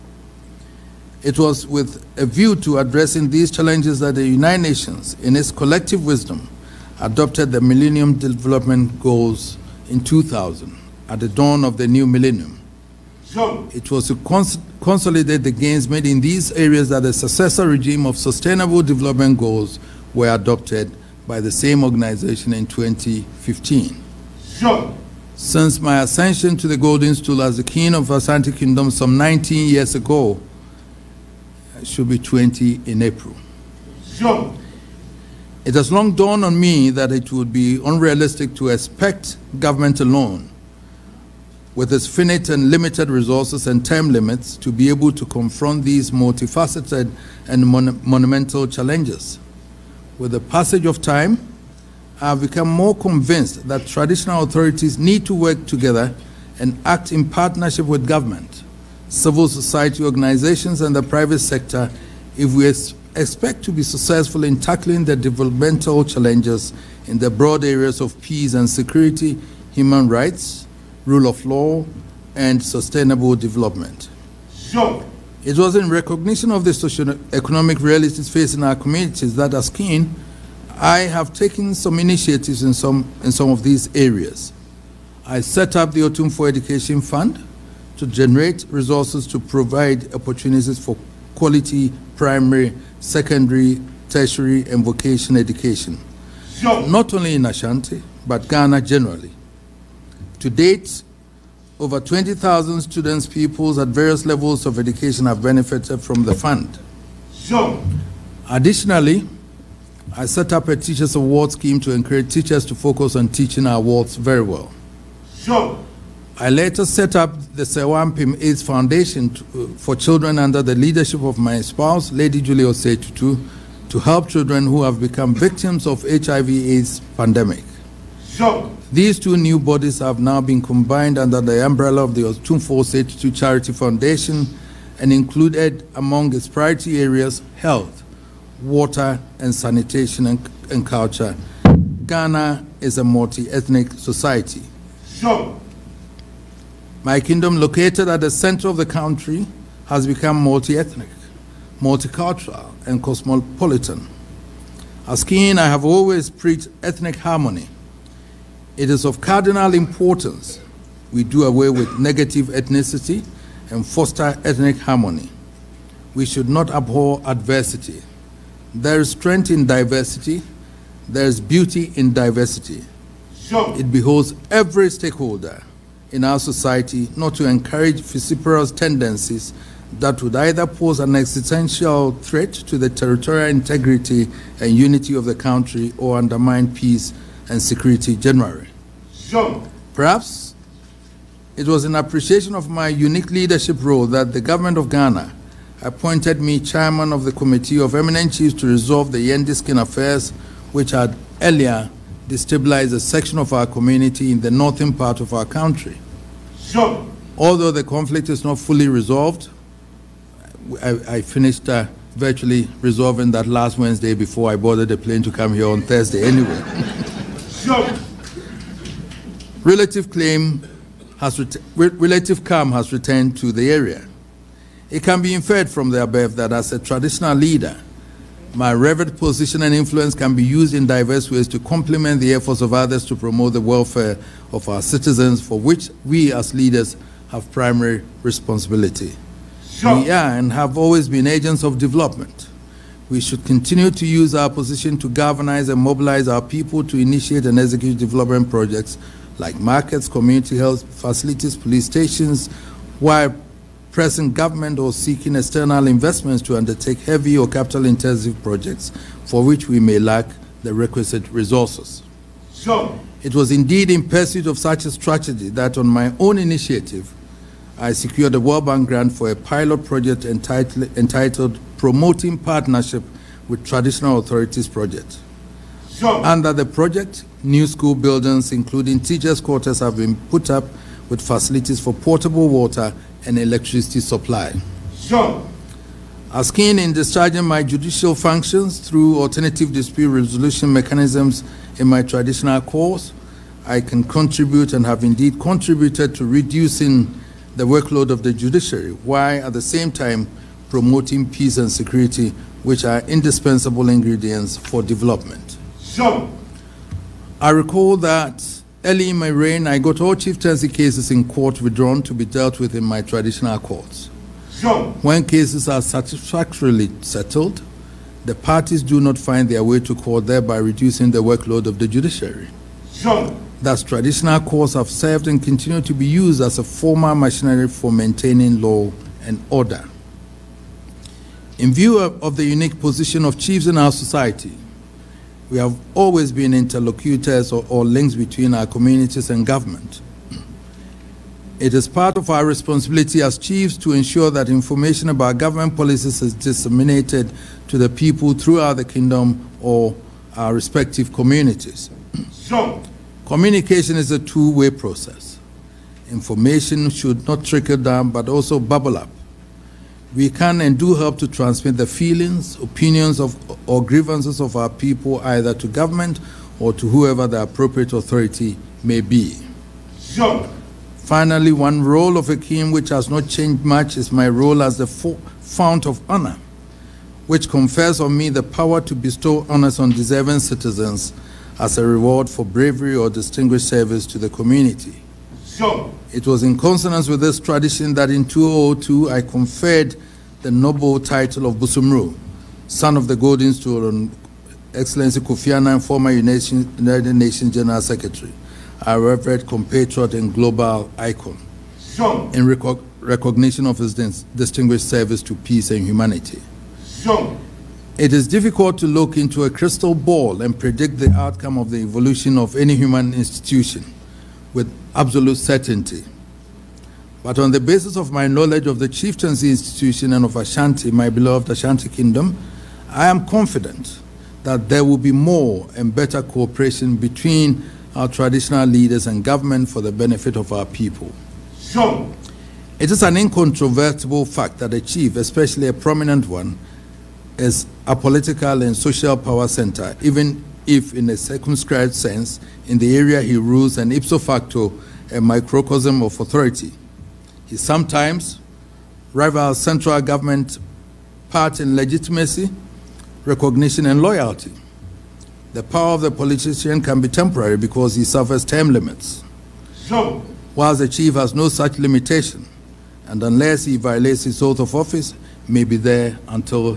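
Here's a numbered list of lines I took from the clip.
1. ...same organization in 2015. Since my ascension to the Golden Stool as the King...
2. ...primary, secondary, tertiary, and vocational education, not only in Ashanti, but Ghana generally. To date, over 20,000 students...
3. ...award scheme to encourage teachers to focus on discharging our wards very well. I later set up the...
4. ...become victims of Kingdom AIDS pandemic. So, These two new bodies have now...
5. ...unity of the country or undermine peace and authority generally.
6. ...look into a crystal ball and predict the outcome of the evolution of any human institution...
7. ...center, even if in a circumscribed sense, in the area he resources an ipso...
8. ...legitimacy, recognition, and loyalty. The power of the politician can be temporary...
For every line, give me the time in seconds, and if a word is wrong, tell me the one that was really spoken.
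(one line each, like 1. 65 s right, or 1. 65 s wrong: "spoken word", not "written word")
1. 21 s right
2. 92 s right
3. 111 s wrong: "teaching", not "discharging"
4. 124 s wrong: "HIV", not "Kingdom"
5. 184 s wrong: "security", not "authority"
6. 408 s right
7. 439 s wrong: "rules", not "resources"
8. 451 s right.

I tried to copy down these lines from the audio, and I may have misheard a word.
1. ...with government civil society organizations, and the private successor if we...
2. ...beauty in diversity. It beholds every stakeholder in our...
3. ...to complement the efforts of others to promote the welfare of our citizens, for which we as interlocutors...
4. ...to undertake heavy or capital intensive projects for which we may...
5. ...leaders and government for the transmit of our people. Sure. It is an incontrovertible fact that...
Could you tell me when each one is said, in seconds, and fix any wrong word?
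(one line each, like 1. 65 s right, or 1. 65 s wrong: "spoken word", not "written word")
1. 57 s wrong: "sector", not "successor"
2. 171 s right
3. 231 s wrong: "leaders", not "interlocutors"
4. 256 s right
5. 428 s wrong: "benefit", not "transmit".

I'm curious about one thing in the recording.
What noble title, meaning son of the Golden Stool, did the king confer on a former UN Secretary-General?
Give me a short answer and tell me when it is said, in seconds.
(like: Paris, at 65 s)
Busumuru, at 391 s.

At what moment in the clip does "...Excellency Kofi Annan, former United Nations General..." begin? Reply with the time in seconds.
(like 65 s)
394 s.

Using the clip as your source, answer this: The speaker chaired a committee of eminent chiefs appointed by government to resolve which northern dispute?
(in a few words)
Yendi Skin affairs.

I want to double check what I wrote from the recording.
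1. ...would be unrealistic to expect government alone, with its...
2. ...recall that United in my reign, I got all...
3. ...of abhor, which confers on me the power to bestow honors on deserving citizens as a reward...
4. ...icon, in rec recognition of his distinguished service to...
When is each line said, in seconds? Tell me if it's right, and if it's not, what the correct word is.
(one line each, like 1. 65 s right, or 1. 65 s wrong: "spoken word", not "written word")
1. 37 s right
2. 307 s wrong: "Early", not "United"
3. 375 s wrong: "honor", not "abhor"
4. 400 s right.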